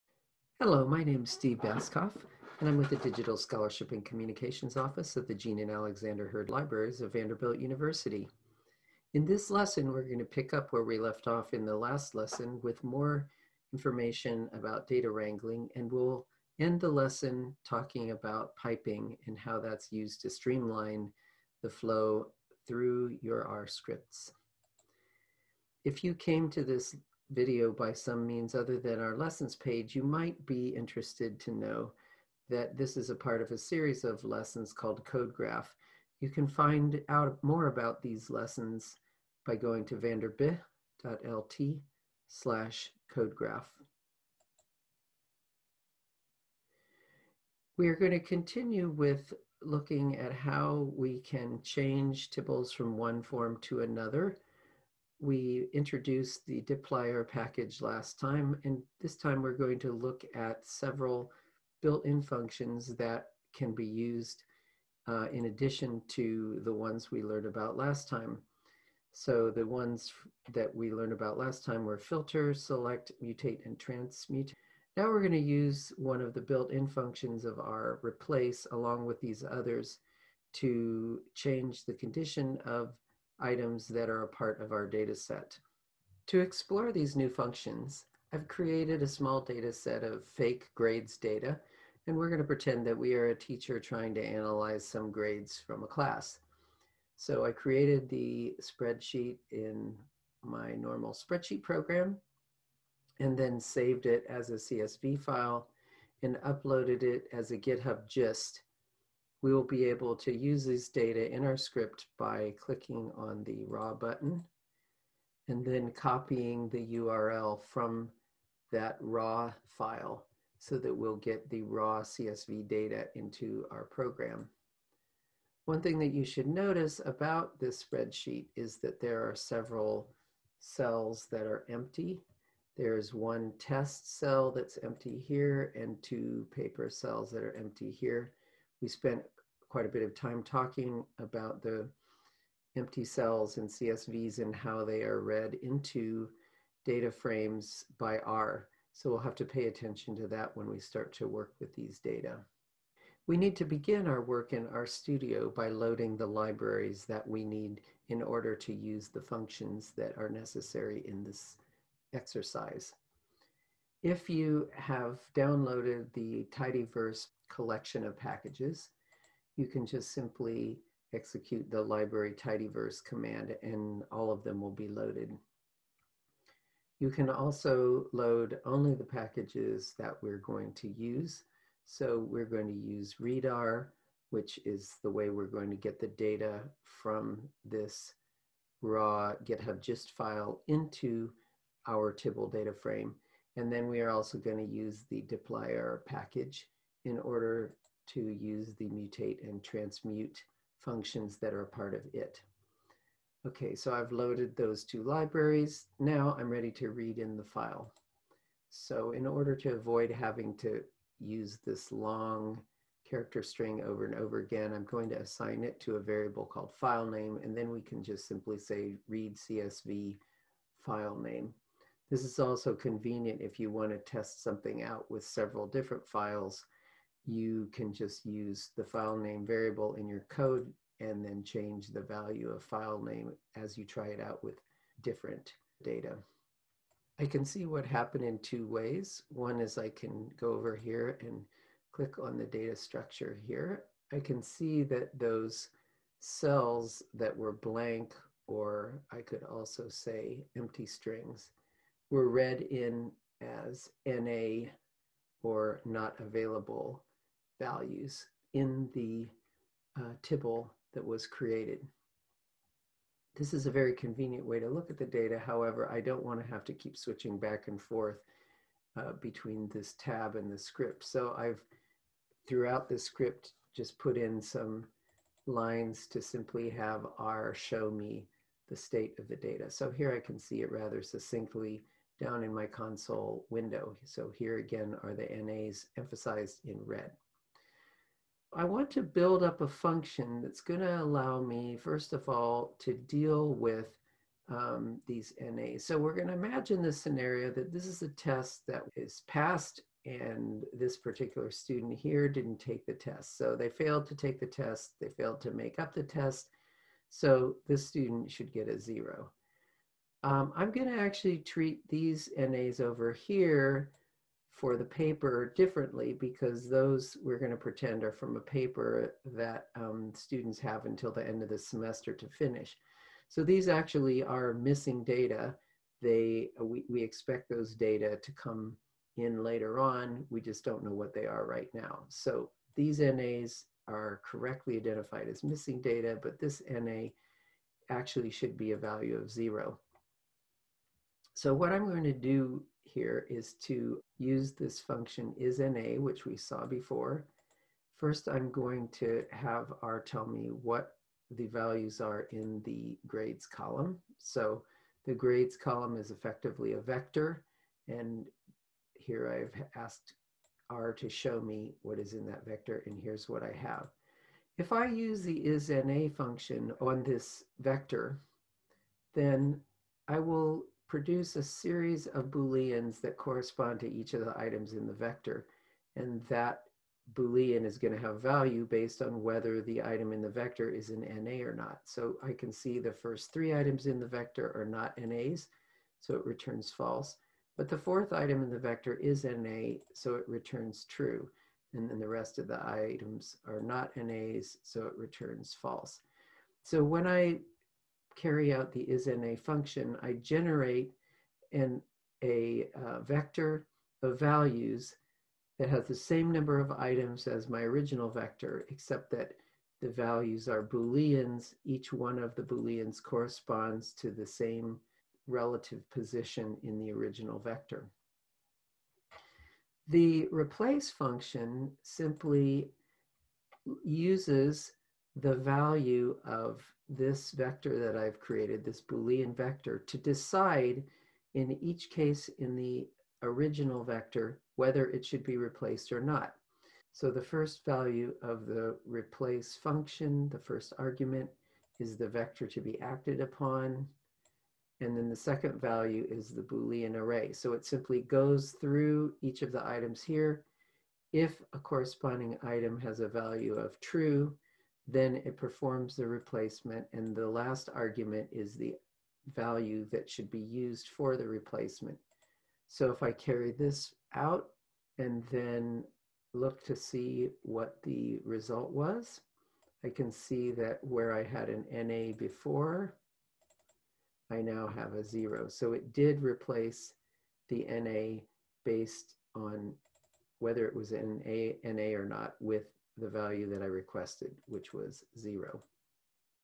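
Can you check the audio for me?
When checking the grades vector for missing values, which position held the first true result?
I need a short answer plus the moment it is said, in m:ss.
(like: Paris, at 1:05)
fourth, at 6:27.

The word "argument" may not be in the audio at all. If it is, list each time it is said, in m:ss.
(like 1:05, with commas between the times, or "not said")
7:20, 7:37.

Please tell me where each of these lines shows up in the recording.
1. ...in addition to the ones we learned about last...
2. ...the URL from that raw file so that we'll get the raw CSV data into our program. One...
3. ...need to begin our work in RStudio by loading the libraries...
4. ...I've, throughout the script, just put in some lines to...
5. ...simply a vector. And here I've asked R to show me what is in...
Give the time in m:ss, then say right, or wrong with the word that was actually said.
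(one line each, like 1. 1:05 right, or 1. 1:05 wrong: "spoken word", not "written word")
1. 1:05 right
2. 1:56 right
3. 2:33 right
4. 4:31 right
5. 5:56 wrong: "effectively", not "simply".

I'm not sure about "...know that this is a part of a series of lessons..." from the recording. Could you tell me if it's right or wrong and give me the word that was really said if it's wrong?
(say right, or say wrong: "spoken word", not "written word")
right.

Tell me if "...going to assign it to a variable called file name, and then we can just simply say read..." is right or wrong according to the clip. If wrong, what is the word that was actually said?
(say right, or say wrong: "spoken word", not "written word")
right.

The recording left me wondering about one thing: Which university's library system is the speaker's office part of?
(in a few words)
Vanderbilt University.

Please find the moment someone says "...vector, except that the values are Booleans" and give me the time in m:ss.
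6:48.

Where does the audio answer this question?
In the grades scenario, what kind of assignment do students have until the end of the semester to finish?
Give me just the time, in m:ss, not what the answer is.
5:18.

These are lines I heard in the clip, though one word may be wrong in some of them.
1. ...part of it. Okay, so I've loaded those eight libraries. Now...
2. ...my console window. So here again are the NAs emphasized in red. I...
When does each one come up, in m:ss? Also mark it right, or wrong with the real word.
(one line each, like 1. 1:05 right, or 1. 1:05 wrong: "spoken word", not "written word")
1. 3:21 wrong: "two", not "eight"
2. 4:42 right.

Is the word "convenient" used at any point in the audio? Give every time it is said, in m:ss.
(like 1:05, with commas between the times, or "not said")
3:42, 4:23.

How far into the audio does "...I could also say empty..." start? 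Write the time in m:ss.
4:09.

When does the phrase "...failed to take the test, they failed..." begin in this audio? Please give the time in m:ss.
5:03.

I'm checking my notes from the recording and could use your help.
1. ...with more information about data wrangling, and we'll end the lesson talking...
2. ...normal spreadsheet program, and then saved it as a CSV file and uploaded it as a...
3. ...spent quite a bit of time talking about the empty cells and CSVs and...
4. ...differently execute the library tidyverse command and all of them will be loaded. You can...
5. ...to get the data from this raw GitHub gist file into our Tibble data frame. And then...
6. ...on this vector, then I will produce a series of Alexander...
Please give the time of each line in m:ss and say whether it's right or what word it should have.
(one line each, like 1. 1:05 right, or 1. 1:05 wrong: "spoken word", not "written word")
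1. 0:12 right
2. 1:40 right
3. 2:18 right
4. 2:50 wrong: "simply", not "differently"
5. 3:05 right
6. 6:06 wrong: "Booleans", not "Alexander".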